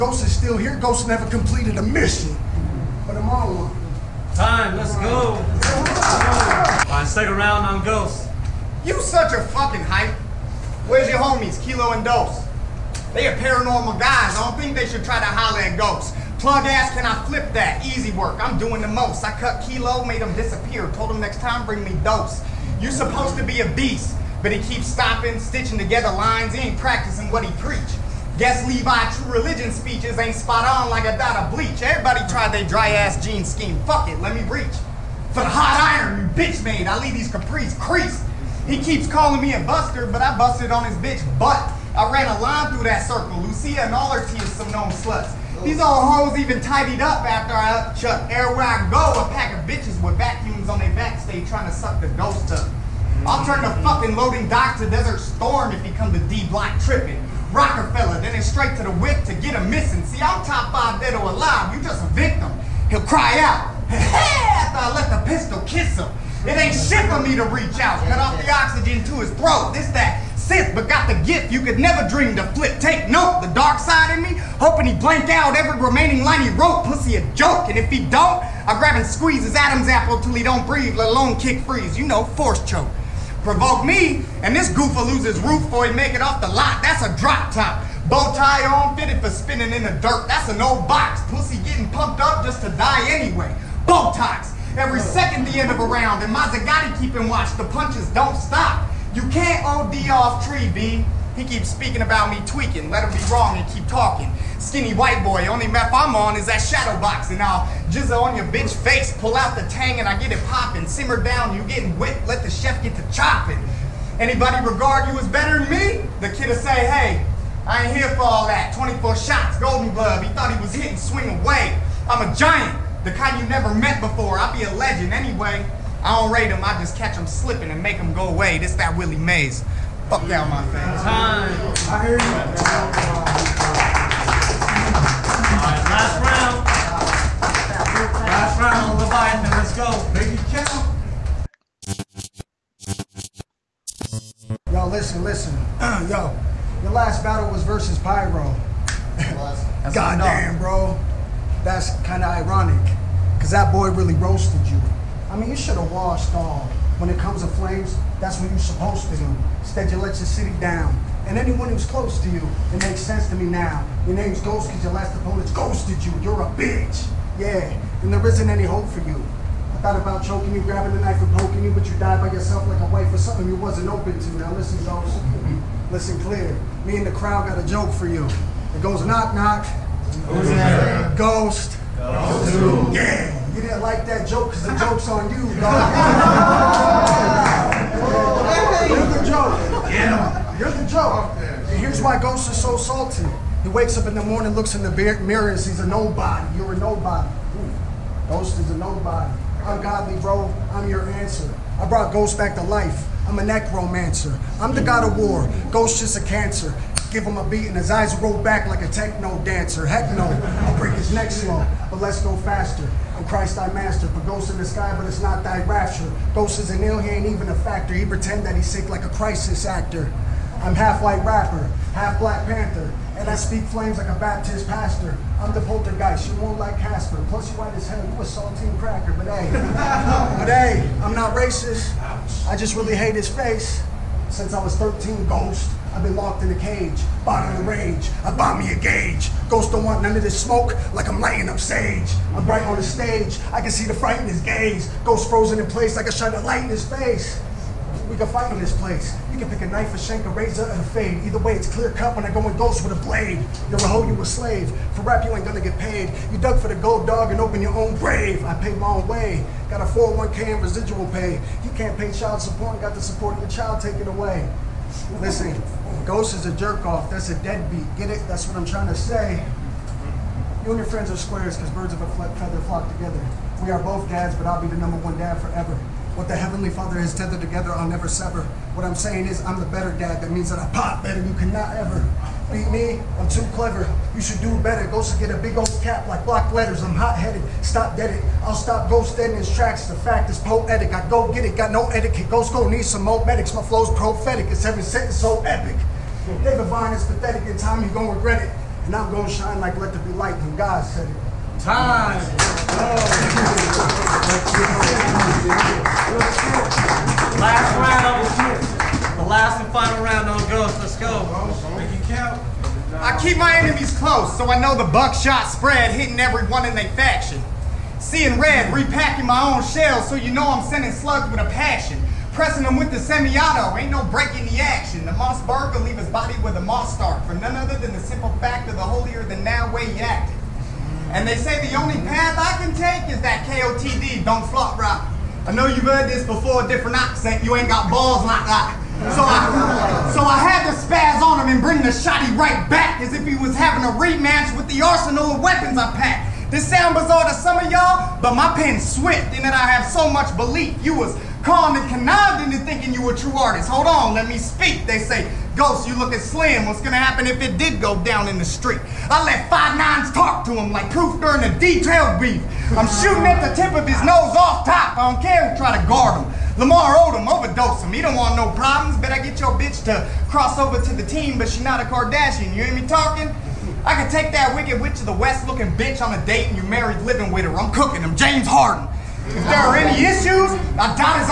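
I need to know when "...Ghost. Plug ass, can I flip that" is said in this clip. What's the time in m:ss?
0:15.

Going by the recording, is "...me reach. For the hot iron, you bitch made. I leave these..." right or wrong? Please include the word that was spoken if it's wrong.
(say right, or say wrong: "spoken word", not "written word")
right.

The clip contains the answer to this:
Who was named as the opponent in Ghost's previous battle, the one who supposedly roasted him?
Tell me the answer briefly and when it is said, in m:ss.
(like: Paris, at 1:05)
Pyro, at 2:27.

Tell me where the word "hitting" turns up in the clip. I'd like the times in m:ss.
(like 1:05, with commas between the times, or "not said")
2:00, 5:15.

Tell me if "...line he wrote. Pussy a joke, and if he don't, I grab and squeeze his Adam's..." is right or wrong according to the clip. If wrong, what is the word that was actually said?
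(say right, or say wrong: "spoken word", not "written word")
right.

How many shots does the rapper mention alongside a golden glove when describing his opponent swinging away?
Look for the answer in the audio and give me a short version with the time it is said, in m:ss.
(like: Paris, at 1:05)
24, at 1:58.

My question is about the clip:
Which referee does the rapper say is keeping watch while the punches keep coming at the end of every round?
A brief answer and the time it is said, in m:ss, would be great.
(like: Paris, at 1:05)
Mazzagatti, at 1:36.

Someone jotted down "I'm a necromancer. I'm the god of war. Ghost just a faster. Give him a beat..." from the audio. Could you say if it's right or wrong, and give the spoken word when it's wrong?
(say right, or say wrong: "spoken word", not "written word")
wrong: "cancer", not "faster".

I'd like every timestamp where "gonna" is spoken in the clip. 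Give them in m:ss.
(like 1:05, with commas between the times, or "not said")
4:15, 5:56.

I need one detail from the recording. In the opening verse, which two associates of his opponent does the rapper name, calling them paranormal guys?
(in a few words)
Kilo and Dose.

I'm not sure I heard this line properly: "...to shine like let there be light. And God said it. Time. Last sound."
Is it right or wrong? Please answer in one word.
wrong.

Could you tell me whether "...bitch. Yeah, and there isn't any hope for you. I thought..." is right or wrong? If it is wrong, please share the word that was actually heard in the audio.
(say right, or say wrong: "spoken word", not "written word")
right.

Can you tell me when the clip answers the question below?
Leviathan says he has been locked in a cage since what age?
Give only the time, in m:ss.
3:54.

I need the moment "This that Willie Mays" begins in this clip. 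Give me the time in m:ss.
2:08.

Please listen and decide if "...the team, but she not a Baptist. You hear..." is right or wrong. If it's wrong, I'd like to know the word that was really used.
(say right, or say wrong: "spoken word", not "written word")
wrong: "Kardashian", not "Baptist".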